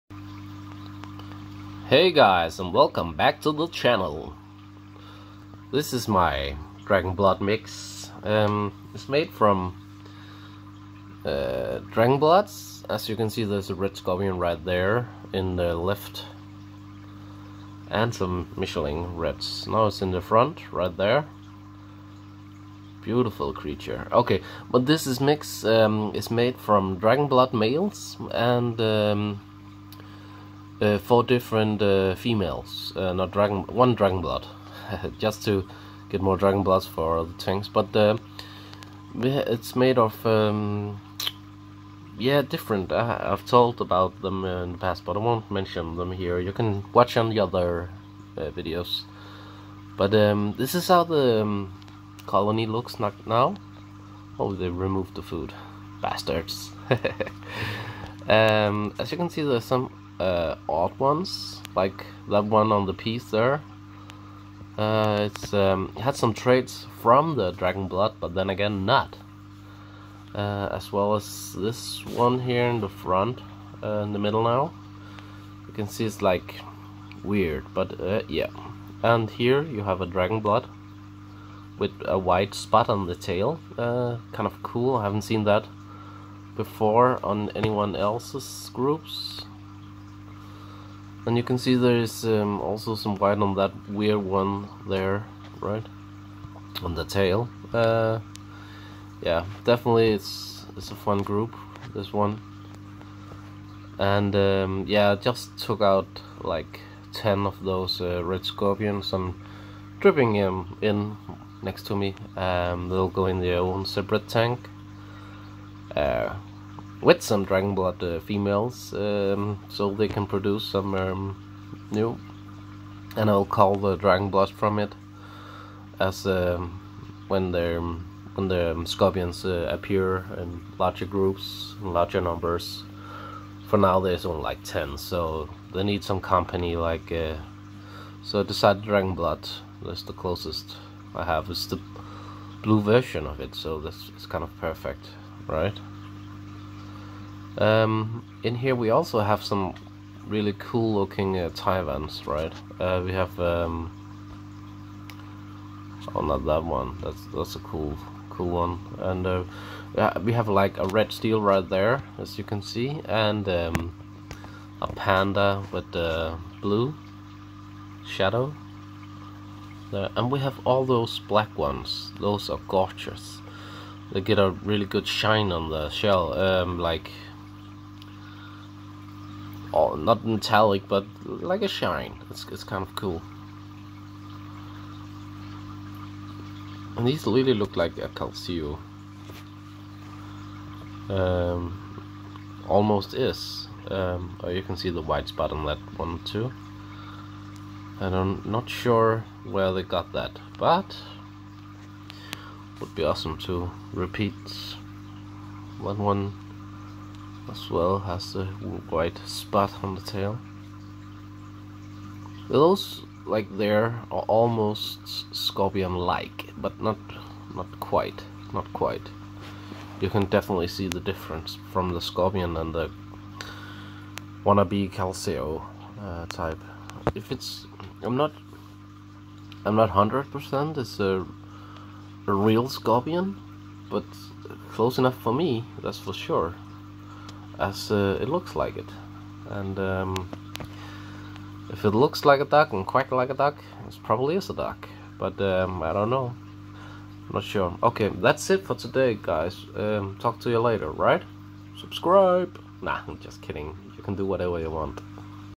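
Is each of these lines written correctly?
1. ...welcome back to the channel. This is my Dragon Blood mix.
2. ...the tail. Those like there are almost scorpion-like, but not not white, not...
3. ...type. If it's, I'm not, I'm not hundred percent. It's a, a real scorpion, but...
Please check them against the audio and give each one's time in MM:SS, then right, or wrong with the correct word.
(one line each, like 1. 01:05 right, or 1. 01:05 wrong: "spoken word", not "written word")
1. 00:02 right
2. 03:29 wrong: "quite", not "white"
3. 03:46 right.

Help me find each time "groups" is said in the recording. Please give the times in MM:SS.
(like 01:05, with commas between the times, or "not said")
01:28, 01:41, 02:11.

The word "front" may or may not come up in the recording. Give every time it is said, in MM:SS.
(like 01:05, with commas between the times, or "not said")
00:20, 01:12.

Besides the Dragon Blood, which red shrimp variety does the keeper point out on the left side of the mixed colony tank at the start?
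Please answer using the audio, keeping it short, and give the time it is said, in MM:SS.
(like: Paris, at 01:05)
Red Scorpion, at 00:13.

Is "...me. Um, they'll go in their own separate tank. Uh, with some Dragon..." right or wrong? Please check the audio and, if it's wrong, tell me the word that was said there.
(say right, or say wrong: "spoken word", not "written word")
right.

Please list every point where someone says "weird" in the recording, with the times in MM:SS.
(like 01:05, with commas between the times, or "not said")
01:17, 01:33.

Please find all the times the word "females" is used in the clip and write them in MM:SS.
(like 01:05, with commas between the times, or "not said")
00:32, 01:58.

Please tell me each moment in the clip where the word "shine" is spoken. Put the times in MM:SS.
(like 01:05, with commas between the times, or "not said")
02:55, 03:01.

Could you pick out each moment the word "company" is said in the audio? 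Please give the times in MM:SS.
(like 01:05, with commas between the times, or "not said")
02:16.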